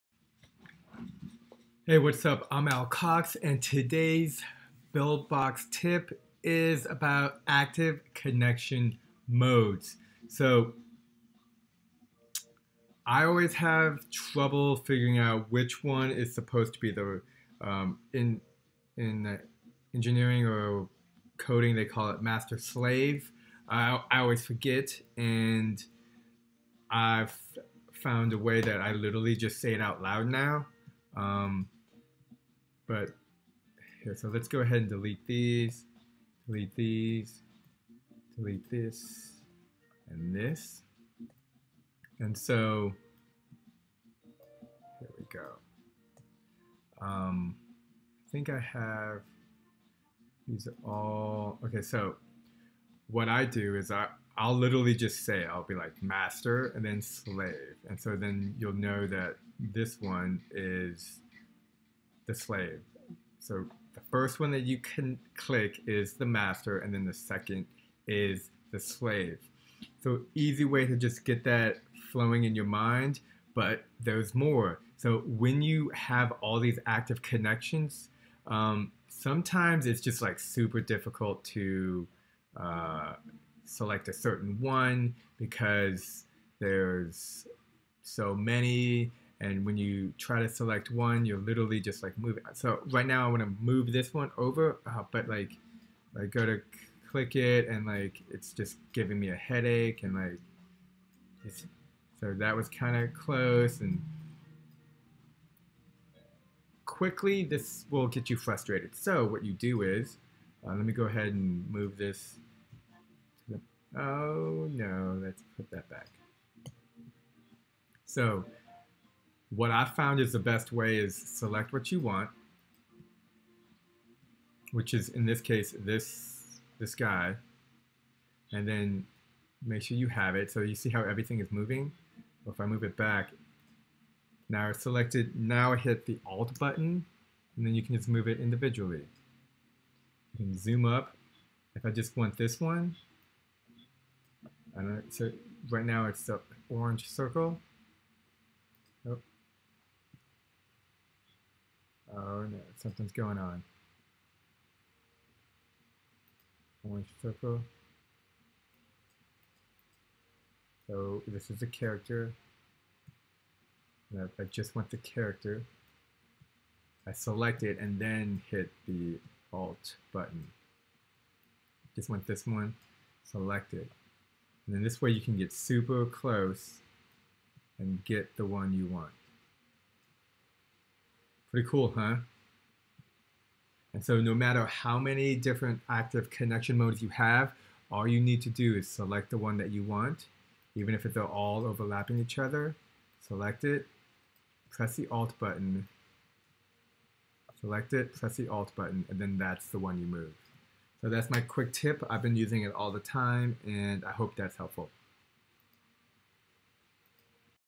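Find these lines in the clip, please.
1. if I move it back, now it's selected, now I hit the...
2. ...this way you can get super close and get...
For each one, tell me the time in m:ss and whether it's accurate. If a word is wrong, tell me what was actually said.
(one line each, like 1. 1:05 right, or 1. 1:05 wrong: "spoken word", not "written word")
1. 2:12 right
2. 2:54 right.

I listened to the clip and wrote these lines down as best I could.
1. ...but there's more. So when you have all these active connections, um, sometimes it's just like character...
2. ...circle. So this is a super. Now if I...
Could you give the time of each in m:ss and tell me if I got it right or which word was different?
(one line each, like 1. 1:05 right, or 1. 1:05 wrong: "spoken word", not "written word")
1. 1:13 wrong: "super", not "character"
2. 2:37 wrong: "character", not "super".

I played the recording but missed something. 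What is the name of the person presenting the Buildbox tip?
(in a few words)
Al Cox.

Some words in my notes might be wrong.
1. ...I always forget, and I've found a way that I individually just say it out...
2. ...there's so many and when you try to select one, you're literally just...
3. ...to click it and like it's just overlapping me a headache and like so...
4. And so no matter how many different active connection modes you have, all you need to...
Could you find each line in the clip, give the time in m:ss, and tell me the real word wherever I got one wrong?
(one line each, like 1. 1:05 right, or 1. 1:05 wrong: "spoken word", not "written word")
1. 0:24 wrong: "literally", not "individually"
2. 1:26 right
3. 1:36 wrong: "giving", not "overlapping"
4. 3:03 right.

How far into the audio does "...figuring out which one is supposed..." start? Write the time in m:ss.
0:14.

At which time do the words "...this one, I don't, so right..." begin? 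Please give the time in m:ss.
2:22.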